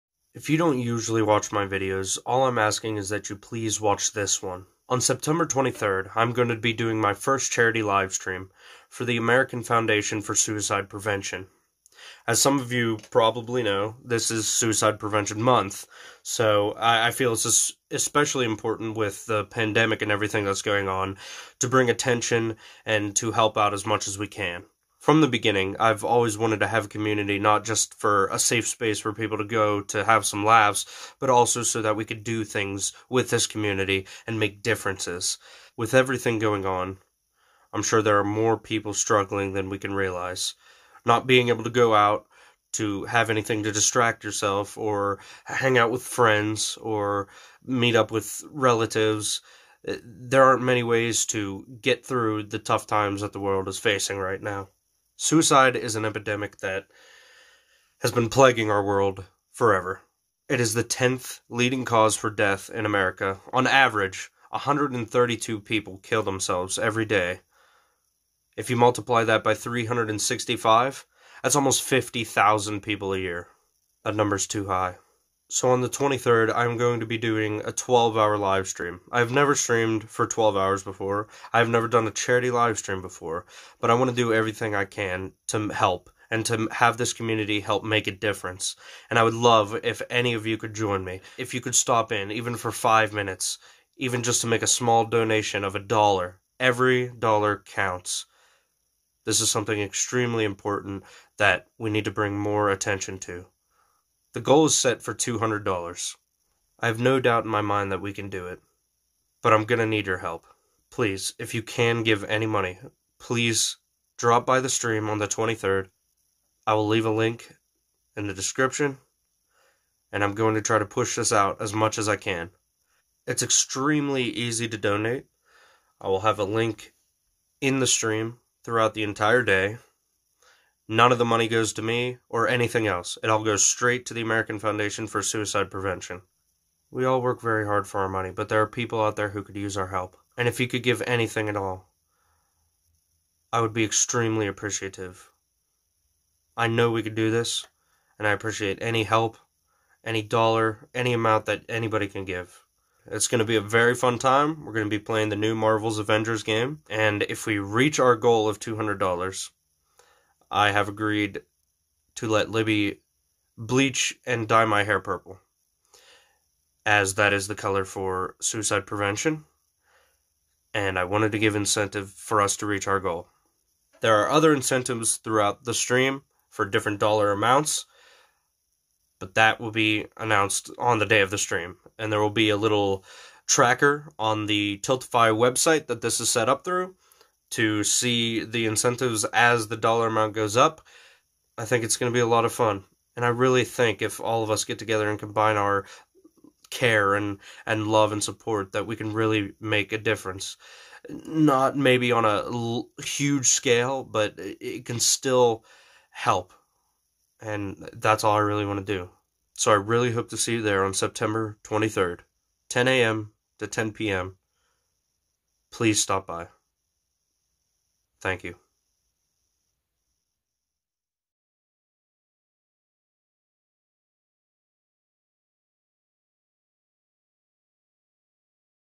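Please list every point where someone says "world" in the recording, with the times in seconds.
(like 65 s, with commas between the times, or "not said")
53 s, 58 s.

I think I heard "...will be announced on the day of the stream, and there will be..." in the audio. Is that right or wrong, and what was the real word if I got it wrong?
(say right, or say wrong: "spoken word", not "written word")
right.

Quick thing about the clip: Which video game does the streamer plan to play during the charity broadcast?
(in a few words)
Marvel's Avengers.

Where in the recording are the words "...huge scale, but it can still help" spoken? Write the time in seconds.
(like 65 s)
203 s.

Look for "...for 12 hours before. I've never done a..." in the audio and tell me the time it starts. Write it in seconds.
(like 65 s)
80 s.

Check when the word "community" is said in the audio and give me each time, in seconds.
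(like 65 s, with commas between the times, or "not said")
26 s, 33 s, 87 s.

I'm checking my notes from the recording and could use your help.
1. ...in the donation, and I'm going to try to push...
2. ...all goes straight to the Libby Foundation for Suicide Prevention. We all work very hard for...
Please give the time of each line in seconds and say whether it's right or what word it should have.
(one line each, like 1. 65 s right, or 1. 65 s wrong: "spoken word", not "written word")
1. 118 s wrong: "description", not "donation"
2. 133 s wrong: "American", not "Libby".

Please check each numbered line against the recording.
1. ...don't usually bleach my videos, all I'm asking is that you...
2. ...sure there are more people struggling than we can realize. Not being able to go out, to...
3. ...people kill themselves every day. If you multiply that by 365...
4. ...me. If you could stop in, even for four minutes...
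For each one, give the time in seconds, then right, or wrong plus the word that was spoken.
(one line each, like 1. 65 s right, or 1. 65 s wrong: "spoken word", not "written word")
1. 0 s wrong: "watch", not "bleach"
2. 37 s right
3. 65 s right
4. 91 s wrong: "five", not "four".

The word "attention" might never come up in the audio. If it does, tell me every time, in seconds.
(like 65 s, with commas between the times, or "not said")
21 s, 102 s.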